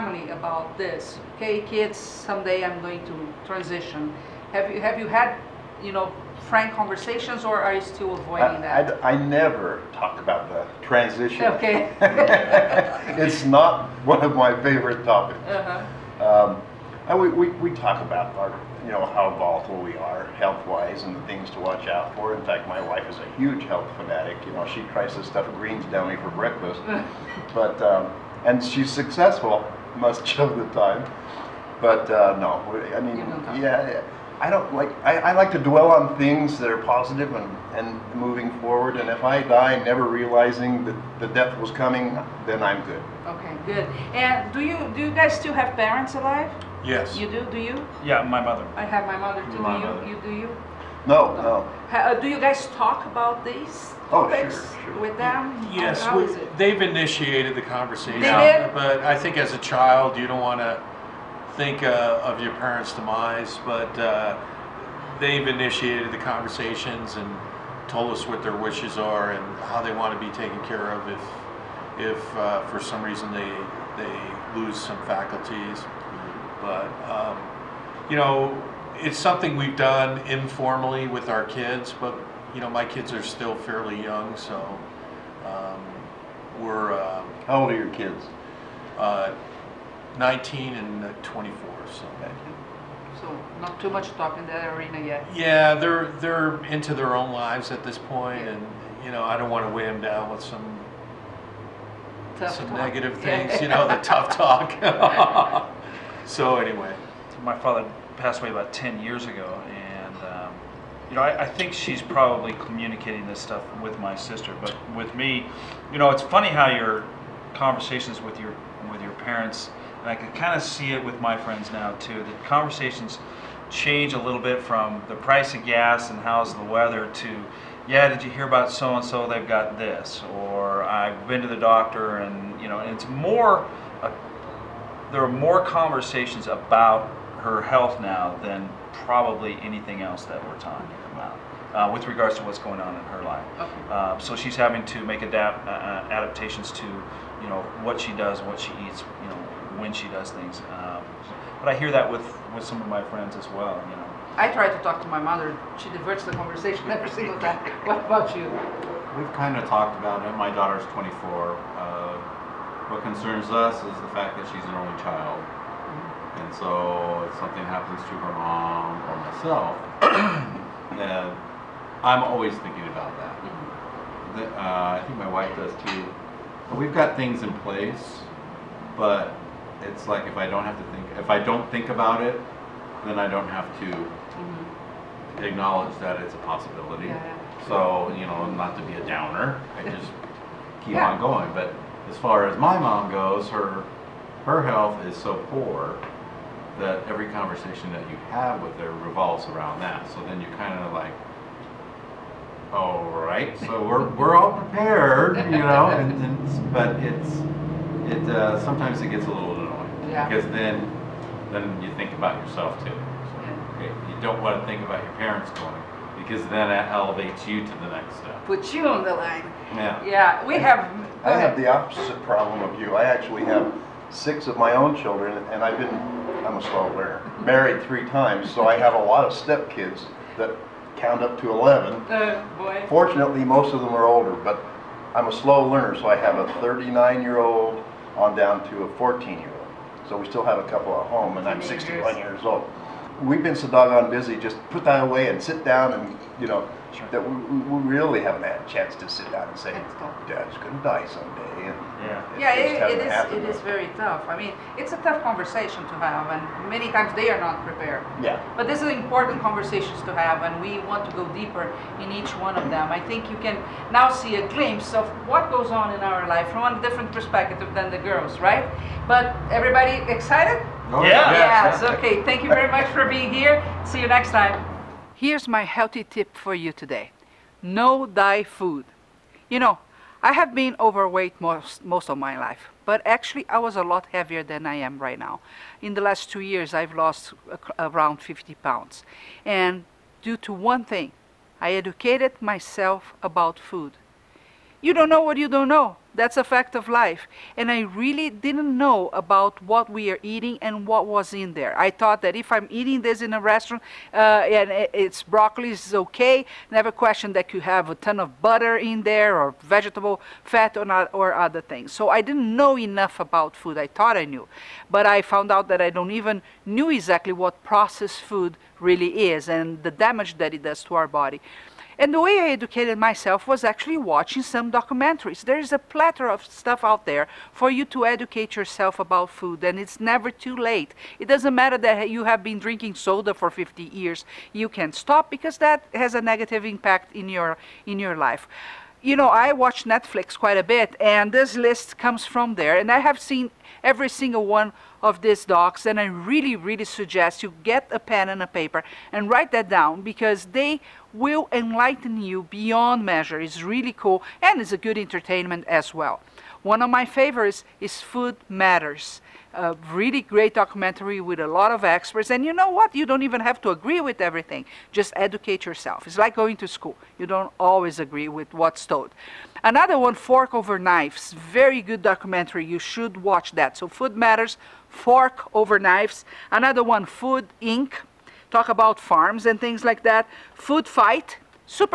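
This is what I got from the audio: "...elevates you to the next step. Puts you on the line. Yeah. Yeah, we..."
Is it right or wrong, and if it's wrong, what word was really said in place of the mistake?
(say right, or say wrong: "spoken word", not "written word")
right.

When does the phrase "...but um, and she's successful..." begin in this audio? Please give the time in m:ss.
0:27.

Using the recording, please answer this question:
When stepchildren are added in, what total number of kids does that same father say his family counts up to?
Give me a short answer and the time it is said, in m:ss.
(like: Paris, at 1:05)
11, at 3:51.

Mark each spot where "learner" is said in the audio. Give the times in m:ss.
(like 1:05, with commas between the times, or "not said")
3:46, 3:55.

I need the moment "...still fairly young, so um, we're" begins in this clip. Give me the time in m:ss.
1:23.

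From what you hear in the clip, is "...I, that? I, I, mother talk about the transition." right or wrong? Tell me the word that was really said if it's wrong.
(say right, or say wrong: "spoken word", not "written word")
wrong: "never", not "mother".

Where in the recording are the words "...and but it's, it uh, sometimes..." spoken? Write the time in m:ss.
3:26.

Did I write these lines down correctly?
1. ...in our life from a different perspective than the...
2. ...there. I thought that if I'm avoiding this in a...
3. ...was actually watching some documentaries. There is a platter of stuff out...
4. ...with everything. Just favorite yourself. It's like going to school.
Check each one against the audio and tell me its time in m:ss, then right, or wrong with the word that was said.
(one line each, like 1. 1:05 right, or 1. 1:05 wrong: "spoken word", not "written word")
1. 4:25 right
2. 5:01 wrong: "eating", not "avoiding"
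3. 5:23 right
4. 6:04 wrong: "educate", not "favorite".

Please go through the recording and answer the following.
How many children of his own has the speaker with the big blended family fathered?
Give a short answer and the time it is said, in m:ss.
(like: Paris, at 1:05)
6, at 3:44.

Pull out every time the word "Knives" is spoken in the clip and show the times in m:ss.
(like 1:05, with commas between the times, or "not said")
6:10, 6:15.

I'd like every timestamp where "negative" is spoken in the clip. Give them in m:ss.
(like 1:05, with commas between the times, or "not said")
1:42, 5:36.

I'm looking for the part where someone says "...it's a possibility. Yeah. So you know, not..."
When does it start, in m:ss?
3:06.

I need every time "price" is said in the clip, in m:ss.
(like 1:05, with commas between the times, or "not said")
2:05.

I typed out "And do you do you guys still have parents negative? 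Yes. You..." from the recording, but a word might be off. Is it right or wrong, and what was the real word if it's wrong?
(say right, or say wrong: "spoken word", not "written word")
wrong: "alive", not "negative".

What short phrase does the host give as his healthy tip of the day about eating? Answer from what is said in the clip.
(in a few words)
Know thy food.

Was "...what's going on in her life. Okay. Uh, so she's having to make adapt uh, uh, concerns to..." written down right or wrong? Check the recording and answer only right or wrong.
wrong.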